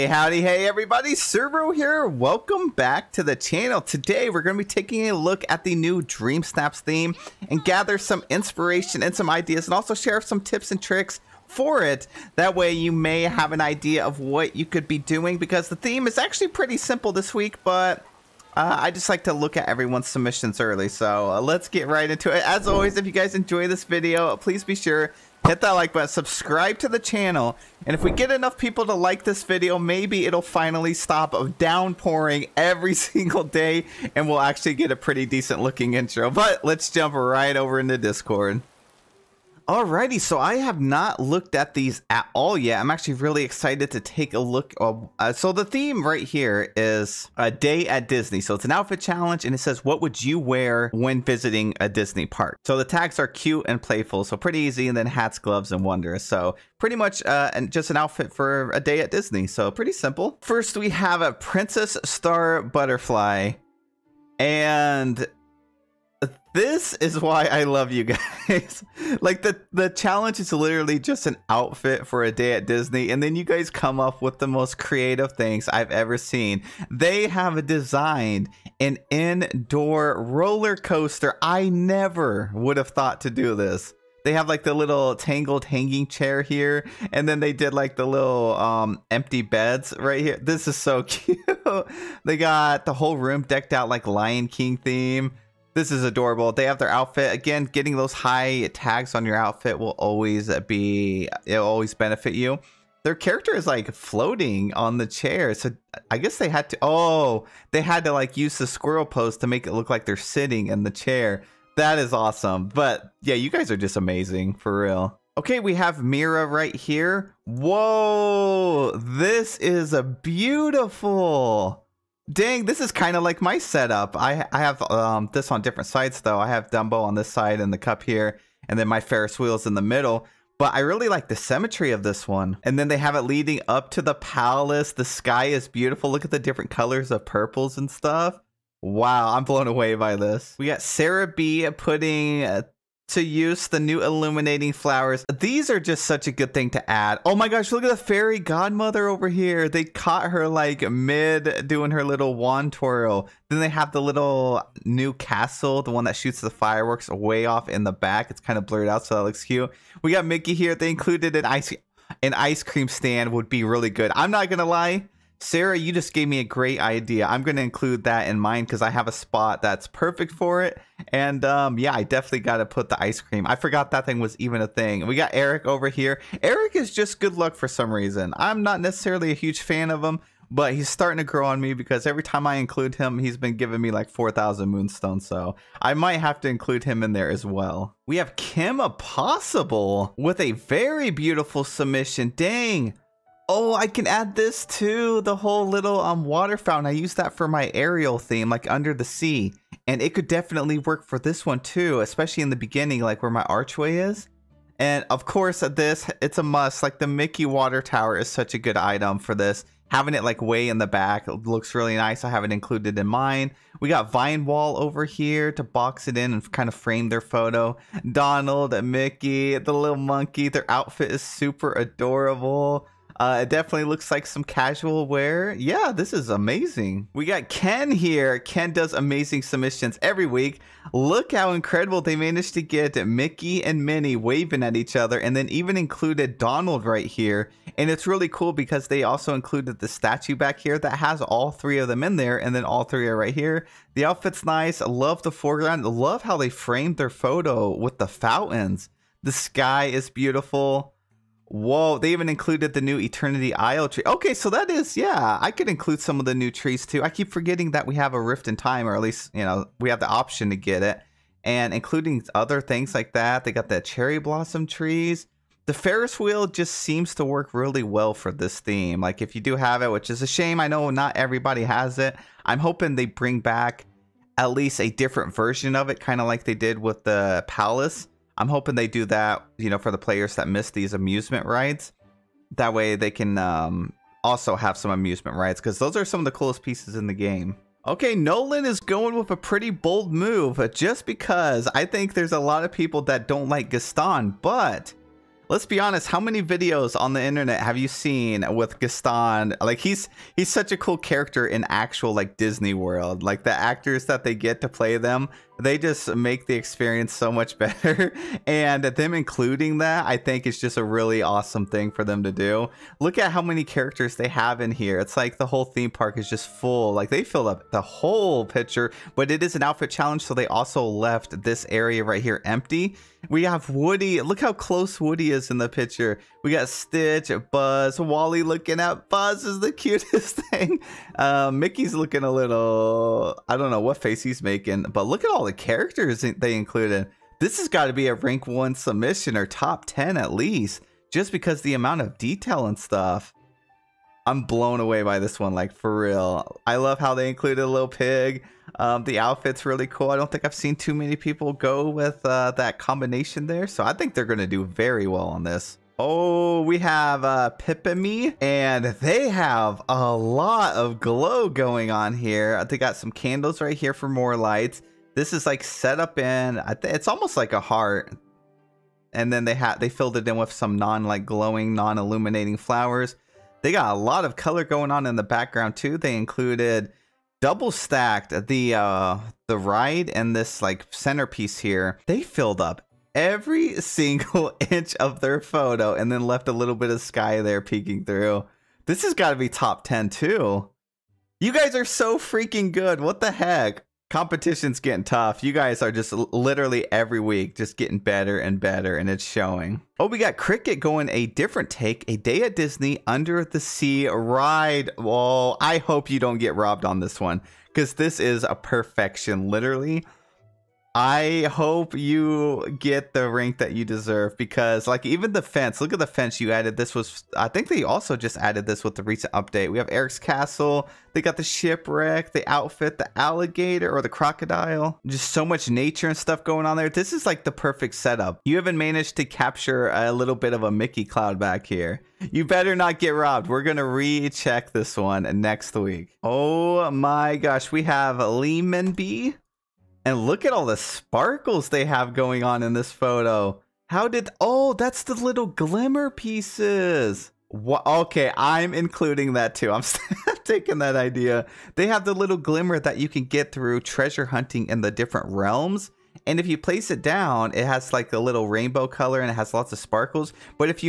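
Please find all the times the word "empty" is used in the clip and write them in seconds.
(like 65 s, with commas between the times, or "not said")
89 s, 322 s.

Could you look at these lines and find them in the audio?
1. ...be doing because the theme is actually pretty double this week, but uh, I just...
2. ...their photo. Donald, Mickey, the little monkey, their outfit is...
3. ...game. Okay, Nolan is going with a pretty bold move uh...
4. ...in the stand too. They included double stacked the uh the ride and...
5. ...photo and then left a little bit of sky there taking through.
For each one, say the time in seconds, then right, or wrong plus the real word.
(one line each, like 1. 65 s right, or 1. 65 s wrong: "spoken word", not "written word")
1. 14 s wrong: "simple", not "double"
2. 217 s right
3. 287 s right
4. 375 s wrong: "background", not "stand"
5. 385 s wrong: "peeking", not "taking".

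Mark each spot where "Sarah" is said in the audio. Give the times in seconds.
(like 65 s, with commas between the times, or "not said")
140 s, 165 s.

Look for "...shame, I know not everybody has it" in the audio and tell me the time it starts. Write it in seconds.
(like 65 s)
270 s.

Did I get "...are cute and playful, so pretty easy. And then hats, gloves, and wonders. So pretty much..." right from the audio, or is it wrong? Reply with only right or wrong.
right.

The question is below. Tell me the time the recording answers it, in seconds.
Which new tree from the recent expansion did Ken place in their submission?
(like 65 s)
252 s.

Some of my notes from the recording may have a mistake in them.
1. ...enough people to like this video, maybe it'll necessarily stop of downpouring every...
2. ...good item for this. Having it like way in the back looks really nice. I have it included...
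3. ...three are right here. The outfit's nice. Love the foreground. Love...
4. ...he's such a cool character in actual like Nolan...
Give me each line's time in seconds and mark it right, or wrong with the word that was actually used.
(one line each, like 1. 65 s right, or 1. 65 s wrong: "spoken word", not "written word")
1. 28 s wrong: "finally", not "necessarily"
2. 208 s right
3. 242 s right
4. 300 s wrong: "Disney", not "Nolan".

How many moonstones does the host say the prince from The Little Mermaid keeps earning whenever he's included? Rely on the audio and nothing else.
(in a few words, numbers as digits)
4,000.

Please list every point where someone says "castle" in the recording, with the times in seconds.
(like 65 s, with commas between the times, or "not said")
155 s, 420 s.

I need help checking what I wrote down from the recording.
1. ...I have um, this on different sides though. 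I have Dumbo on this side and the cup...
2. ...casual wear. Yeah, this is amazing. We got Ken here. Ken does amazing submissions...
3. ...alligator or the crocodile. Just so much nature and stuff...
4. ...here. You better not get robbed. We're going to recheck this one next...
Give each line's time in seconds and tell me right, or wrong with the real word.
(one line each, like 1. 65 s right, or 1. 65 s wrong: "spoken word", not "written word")
1. 124 s right
2. 224 s right
3. 423 s right
4. 431 s right.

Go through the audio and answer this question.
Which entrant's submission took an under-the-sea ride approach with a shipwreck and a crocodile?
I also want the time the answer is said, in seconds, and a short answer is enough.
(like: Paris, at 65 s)
Cricket, at 400 s.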